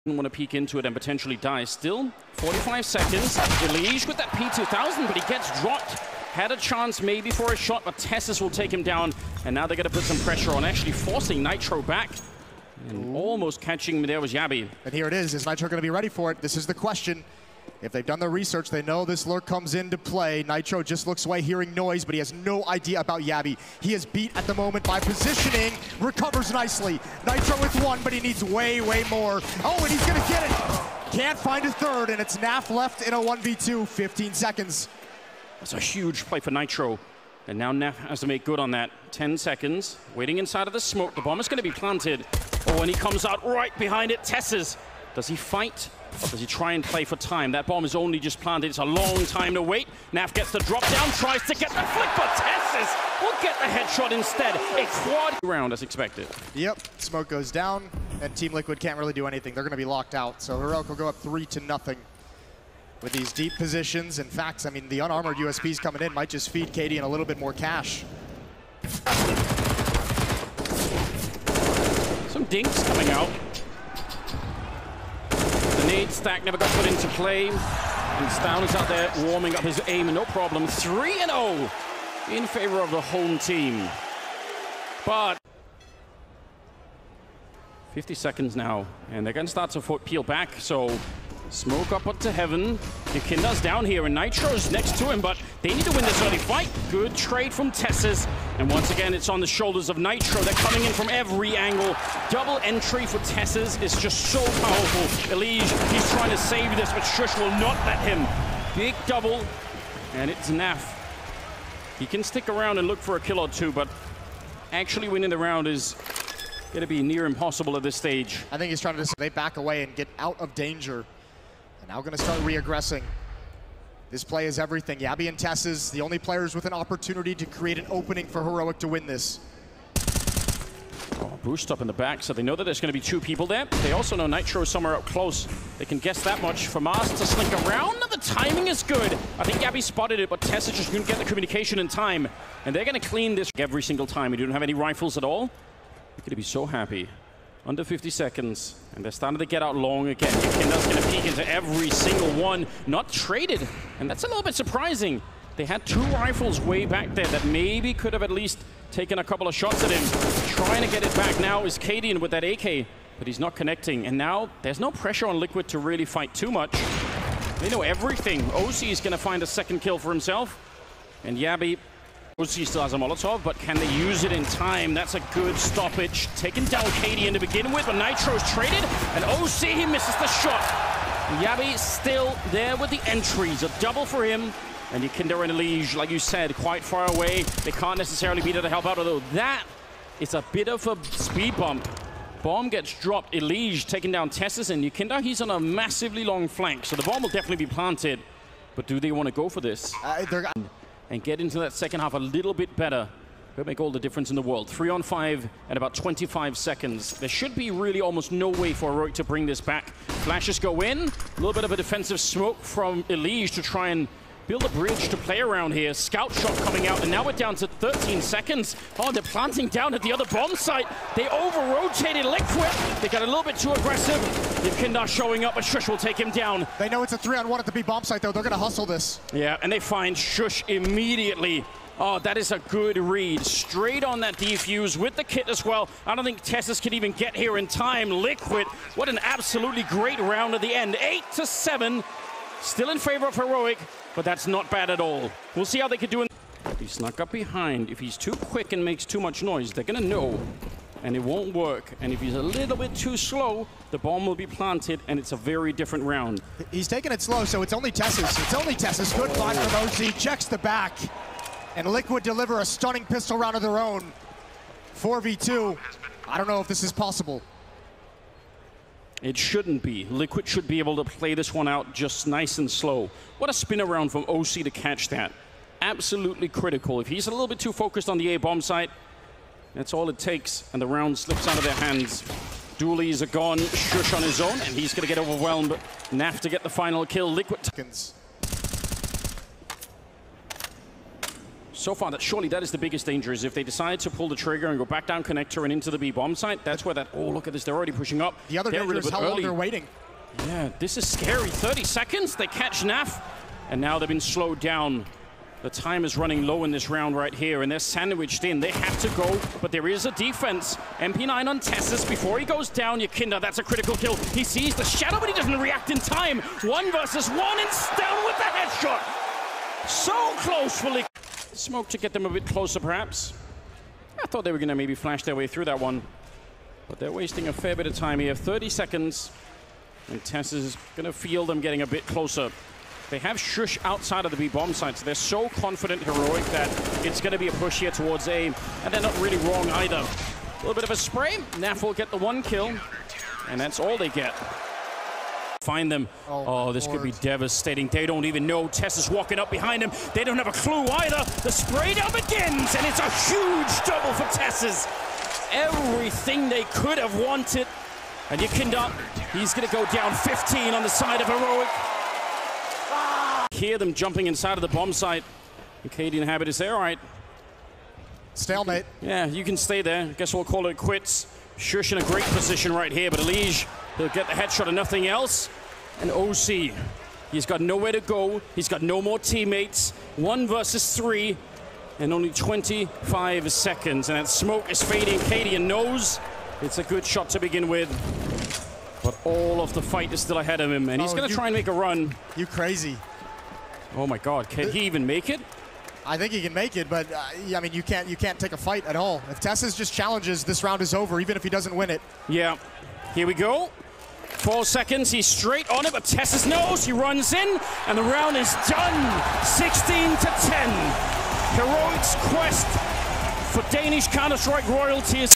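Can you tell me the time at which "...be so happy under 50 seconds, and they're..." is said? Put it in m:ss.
2:26.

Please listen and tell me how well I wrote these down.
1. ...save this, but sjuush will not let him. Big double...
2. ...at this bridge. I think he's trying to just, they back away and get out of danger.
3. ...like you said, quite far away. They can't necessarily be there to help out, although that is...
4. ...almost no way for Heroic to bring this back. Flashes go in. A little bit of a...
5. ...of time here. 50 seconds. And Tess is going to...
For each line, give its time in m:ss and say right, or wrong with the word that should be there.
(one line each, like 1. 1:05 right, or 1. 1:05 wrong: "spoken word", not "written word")
1. 1:46 right
2. 1:57 wrong: "stage", not "bridge"
3. 3:05 right
4. 3:27 right
5. 5:27 wrong: "30", not "50".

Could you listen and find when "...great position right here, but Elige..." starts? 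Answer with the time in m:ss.
6:12.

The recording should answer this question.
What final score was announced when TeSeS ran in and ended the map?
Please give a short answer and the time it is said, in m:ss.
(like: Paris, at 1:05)
16-10, at 6:49.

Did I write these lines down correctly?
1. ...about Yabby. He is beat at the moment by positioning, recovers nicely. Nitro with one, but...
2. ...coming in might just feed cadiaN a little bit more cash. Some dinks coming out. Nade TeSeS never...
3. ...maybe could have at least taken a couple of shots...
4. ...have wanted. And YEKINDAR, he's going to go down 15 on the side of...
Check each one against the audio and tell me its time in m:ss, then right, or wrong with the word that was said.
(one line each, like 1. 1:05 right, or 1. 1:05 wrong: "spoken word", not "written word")
1. 0:22 right
2. 1:05 wrong: "Stack", not "TeSeS"
3. 2:37 right
4. 5:56 right.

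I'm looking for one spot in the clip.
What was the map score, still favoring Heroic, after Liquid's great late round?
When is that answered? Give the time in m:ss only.
4:00.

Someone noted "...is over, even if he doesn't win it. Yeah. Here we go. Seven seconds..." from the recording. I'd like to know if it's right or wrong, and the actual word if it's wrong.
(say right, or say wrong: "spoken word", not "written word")
wrong: "Four", not "Seven".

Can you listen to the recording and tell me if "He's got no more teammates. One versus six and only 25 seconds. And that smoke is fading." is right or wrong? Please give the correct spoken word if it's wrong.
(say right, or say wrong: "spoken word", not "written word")
wrong: "three", not "six".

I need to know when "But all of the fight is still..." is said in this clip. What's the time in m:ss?
6:29.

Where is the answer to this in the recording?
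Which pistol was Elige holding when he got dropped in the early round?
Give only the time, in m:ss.
0:04.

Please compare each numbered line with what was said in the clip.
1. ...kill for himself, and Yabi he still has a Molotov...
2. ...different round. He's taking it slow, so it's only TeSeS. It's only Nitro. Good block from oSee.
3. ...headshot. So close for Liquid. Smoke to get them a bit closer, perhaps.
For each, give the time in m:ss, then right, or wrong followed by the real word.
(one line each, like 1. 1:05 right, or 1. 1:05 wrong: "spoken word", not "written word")
1. 2:49 right
2. 4:15 wrong: "TeSeS", not "Nitro"
3. 5:18 right.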